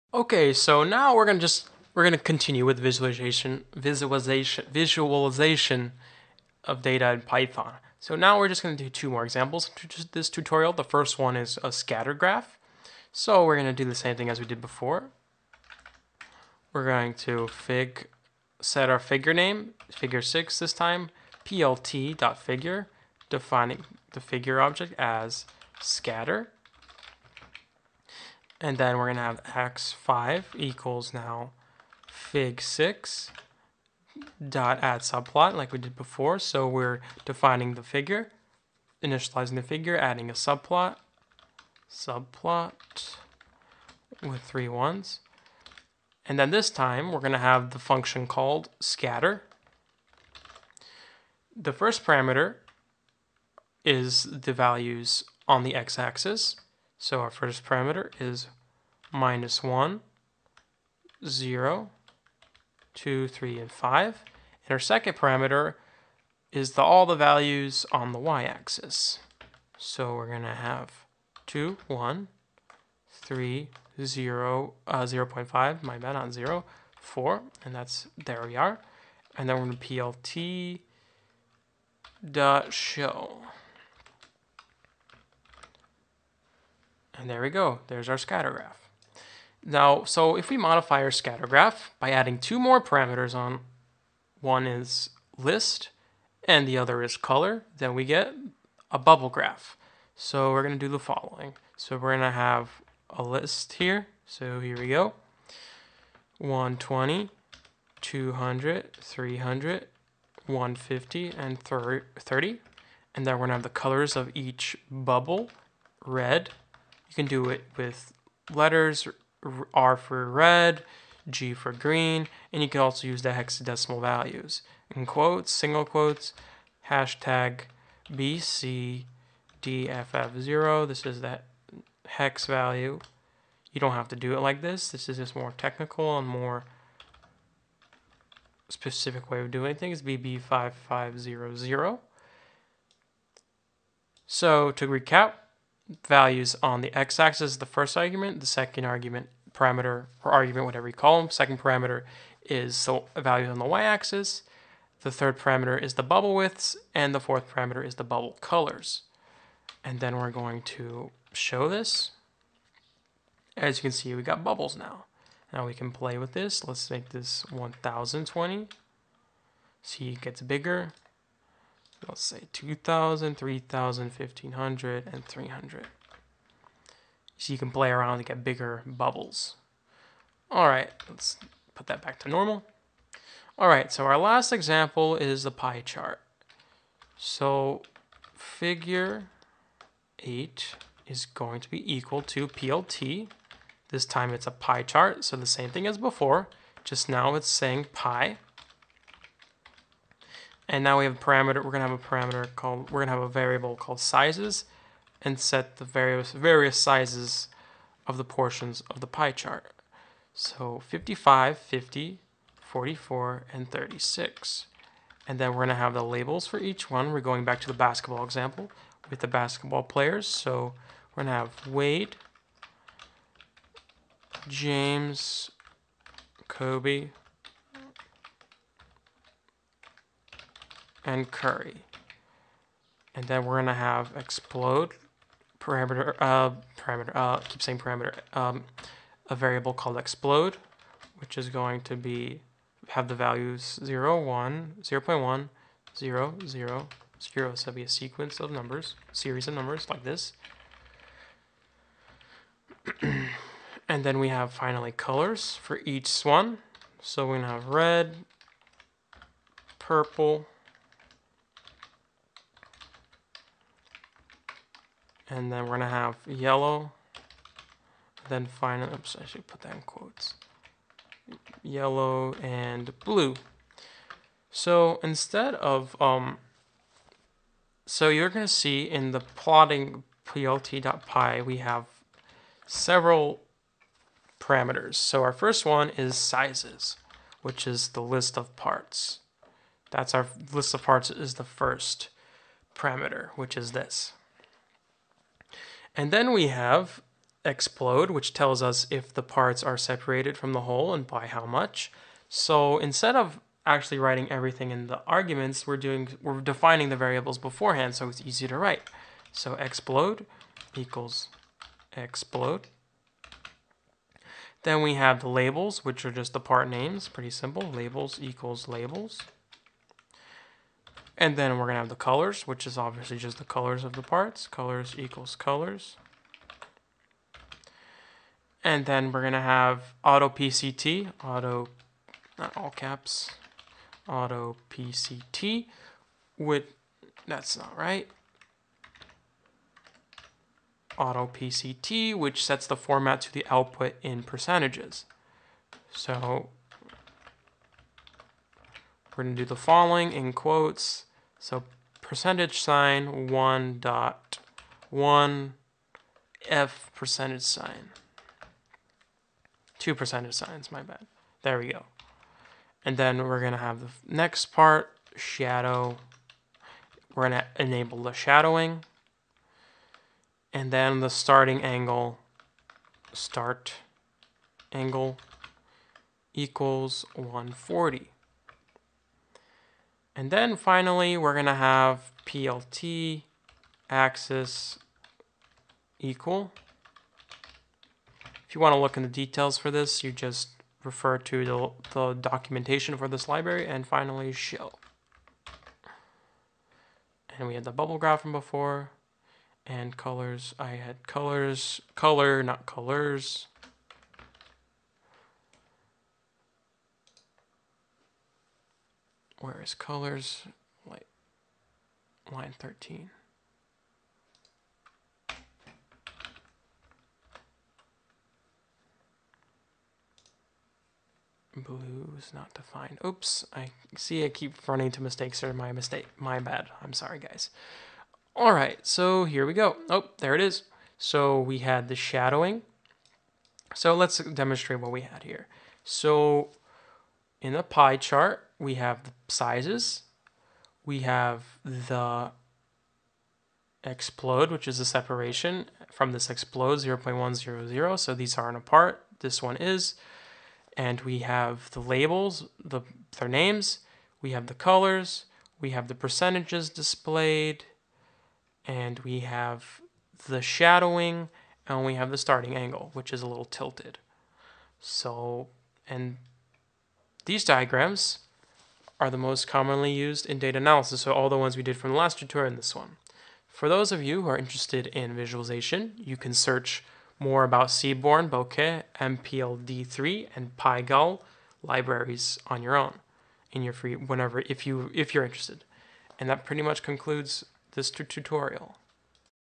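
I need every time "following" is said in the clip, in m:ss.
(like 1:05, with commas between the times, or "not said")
1:40, 5:49.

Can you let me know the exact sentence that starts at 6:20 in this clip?
And then finally, we're going to have plt axis equal.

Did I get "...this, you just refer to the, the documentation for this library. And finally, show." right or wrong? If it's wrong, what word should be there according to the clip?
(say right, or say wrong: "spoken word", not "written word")
right.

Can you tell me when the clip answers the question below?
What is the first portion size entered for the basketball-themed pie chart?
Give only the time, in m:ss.
3:30.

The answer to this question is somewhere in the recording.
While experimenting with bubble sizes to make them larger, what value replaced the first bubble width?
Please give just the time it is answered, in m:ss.
2:47.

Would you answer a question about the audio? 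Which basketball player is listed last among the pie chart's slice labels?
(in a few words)
Curry.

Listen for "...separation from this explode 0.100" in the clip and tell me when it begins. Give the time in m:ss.
7:24.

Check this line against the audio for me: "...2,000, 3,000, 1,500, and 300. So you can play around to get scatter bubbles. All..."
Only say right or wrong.
wrong.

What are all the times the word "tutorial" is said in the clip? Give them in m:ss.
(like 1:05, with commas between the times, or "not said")
0:10, 7:52, 8:07.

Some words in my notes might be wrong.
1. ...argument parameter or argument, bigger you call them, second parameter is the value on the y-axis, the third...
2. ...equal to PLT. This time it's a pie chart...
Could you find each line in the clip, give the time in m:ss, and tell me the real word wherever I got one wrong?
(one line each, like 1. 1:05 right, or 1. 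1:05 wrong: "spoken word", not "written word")
1. 2:28 wrong: "whatever", not "bigger"
2. 3:11 right.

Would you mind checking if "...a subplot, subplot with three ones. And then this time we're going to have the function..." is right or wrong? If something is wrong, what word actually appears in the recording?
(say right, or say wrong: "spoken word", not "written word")
right.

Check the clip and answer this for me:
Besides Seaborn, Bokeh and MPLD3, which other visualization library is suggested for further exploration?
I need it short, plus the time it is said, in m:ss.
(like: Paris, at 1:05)
Pygal, at 8:00.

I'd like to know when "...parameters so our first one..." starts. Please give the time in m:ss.
4:44.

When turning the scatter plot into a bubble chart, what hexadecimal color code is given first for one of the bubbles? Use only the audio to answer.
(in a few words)
#BCDFF0.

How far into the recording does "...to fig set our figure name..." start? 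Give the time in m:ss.
0:17.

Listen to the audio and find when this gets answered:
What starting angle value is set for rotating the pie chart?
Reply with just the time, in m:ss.
6:17.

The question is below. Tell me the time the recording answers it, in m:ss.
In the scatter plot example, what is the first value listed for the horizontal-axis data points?
0:59.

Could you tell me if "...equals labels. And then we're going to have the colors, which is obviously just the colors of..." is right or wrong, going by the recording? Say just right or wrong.
right.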